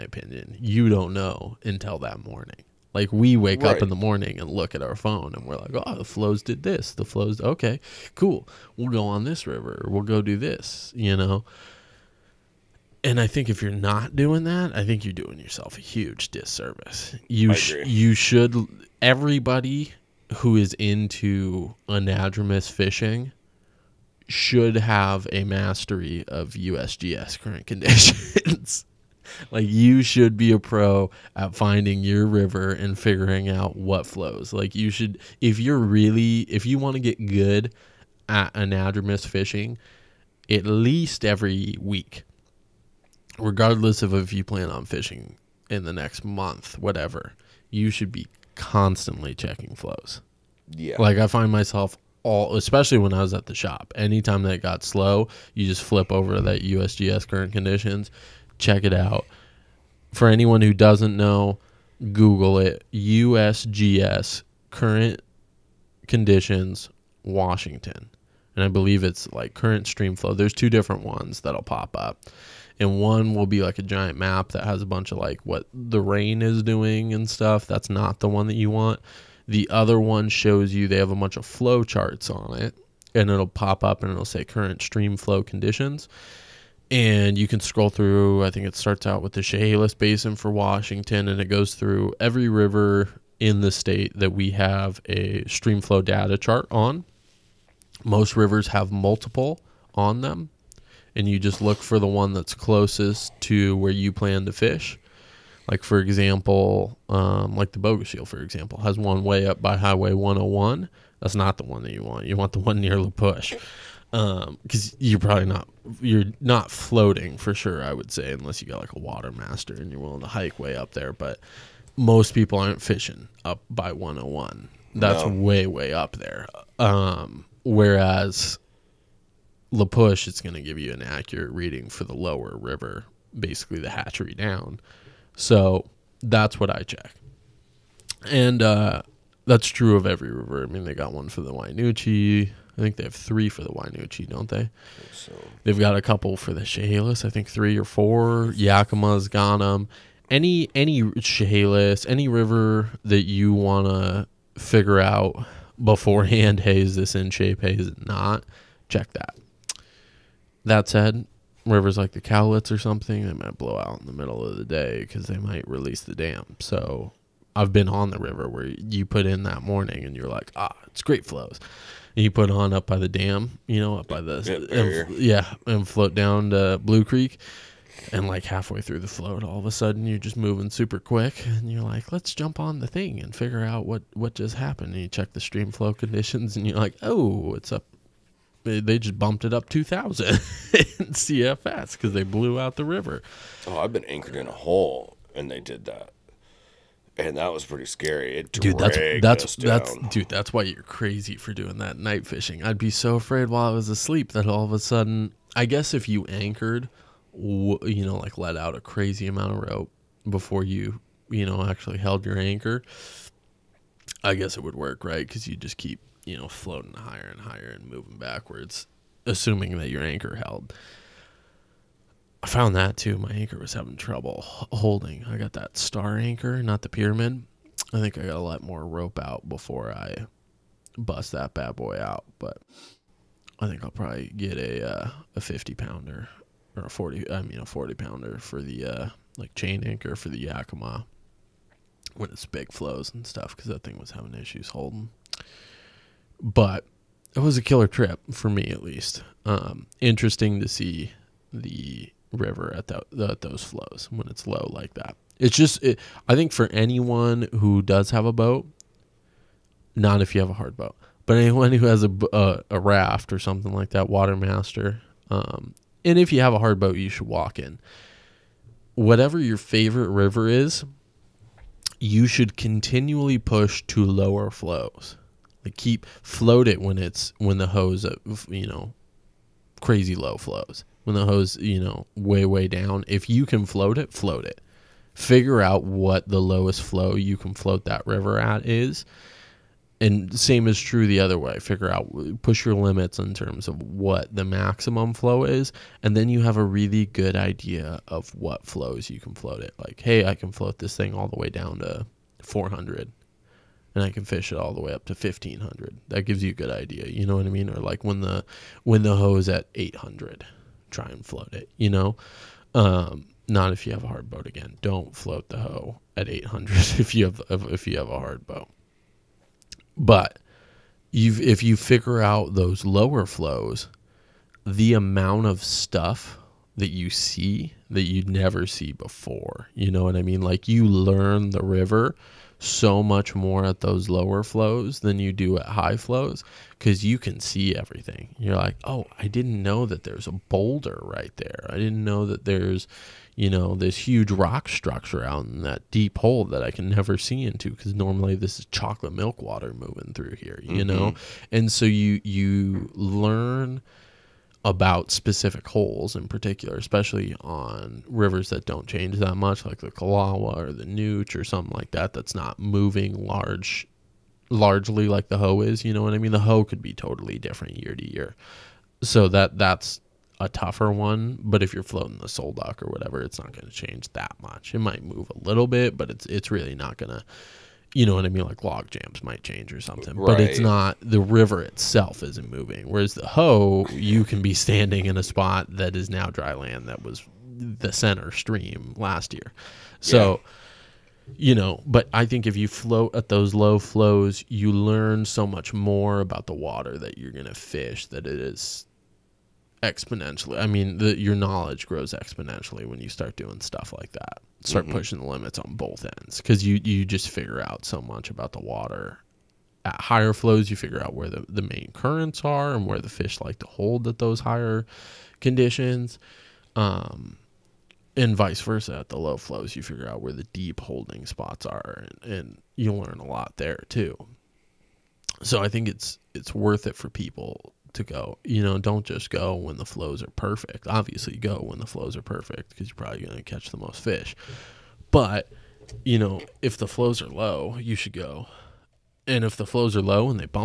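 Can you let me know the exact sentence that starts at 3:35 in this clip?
Because you just keep you know, floating higher and higher and moving backwards, assuming that your anchor held.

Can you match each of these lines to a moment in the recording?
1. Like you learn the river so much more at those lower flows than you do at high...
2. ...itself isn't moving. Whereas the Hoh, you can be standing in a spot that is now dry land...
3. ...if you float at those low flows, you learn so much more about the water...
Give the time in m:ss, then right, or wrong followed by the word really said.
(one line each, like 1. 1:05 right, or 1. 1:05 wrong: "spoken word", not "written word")
1. 5:30 right
2. 6:21 right
3. 6:32 right.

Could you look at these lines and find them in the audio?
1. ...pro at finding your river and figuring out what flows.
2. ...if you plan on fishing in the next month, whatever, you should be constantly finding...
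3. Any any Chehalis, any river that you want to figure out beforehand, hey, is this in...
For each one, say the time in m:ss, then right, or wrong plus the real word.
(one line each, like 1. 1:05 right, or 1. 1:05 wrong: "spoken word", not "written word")
1. 0:30 right
2. 0:44 wrong: "checking", not "finding"
3. 2:30 right.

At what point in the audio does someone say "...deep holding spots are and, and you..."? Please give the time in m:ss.
7:00.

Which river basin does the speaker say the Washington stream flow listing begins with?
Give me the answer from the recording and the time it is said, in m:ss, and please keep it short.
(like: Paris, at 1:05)
Chehalis Basin, at 1:29.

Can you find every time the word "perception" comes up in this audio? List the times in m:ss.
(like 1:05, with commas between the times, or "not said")
not said.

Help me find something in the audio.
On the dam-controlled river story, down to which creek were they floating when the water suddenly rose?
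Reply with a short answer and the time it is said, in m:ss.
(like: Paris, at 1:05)
Blue Creek, at 2:56.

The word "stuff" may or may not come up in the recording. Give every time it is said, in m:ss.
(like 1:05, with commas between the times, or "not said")
1:17, 4:03, 5:25, 6:43.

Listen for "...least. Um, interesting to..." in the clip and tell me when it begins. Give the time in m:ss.
4:08.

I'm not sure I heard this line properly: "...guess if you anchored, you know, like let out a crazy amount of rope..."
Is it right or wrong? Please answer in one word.
right.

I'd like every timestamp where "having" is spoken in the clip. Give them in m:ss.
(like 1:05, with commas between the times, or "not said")
3:43, 4:04.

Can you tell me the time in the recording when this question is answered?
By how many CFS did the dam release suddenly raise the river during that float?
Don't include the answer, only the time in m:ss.
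3:09.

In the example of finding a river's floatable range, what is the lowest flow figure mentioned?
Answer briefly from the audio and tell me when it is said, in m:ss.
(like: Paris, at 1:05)
400, at 5:02.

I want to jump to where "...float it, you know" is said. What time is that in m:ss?
5:11.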